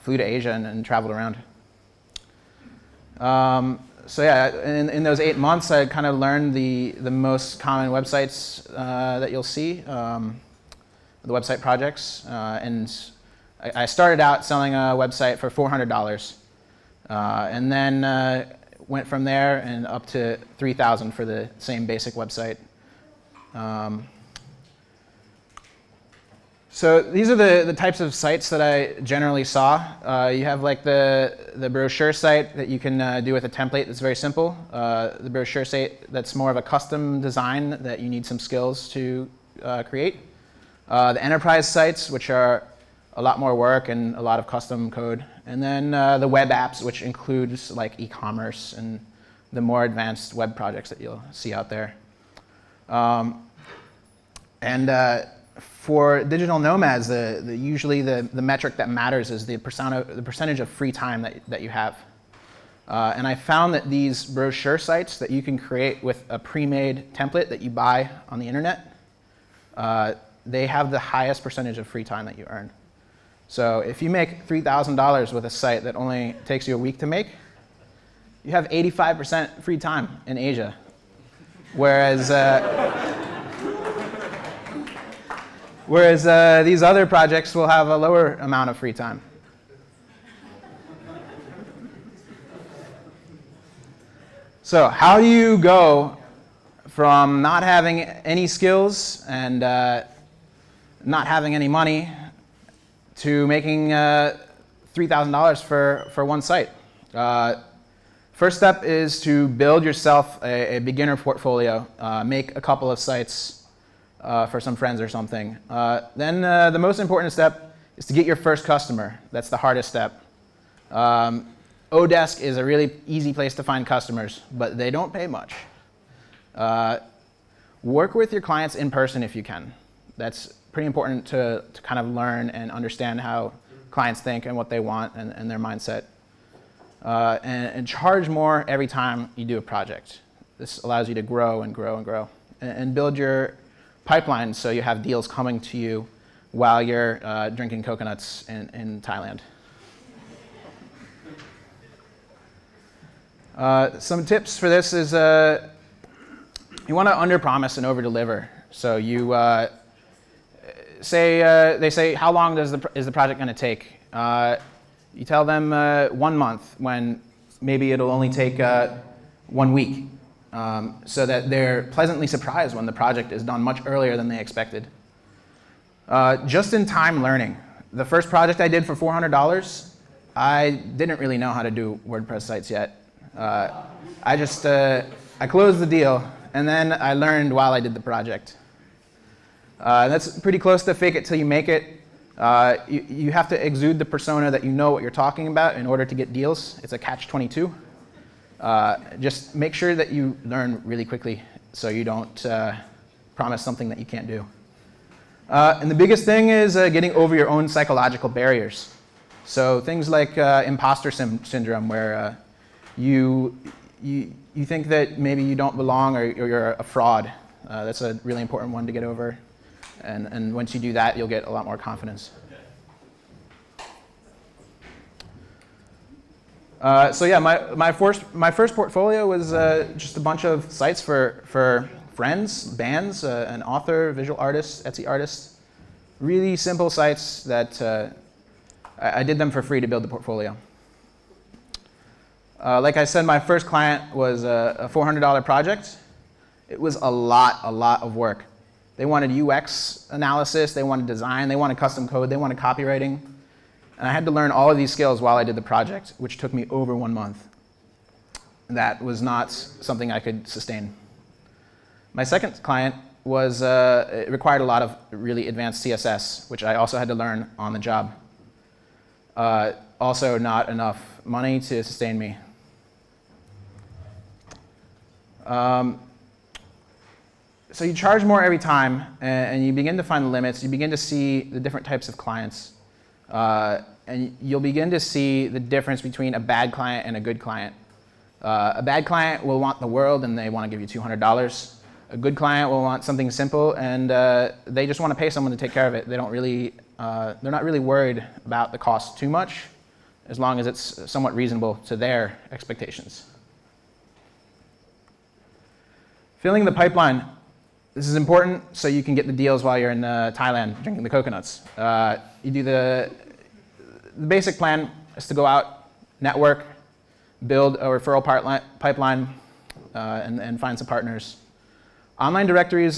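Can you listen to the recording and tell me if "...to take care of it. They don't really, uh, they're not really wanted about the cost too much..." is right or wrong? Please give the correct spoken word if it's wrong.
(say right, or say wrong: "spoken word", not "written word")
wrong: "worried", not "wanted".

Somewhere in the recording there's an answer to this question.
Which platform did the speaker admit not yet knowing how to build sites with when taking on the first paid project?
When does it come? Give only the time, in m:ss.
3:02.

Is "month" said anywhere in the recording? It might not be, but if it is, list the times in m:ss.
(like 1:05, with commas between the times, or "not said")
0:05, 2:46, 4:17.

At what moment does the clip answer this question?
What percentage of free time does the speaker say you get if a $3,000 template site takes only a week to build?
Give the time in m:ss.
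1:18.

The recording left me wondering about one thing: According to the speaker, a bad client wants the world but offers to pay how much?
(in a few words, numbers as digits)
$200.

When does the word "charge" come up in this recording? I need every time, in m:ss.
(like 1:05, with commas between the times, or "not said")
2:17, 4:37.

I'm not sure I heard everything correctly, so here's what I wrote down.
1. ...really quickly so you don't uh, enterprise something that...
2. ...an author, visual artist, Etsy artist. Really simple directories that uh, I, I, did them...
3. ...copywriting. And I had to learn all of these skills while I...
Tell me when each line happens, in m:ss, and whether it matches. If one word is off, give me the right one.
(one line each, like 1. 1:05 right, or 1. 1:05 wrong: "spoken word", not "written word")
1. 3:20 wrong: "promise", not "enterprise"
2. 3:53 wrong: "sites", not "directories"
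3. 4:12 right.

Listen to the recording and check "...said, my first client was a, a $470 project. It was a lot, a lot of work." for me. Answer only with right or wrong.
wrong.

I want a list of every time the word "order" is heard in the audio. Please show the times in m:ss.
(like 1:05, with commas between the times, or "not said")
3:15.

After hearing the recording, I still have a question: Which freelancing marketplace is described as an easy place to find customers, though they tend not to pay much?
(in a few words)
Odesk.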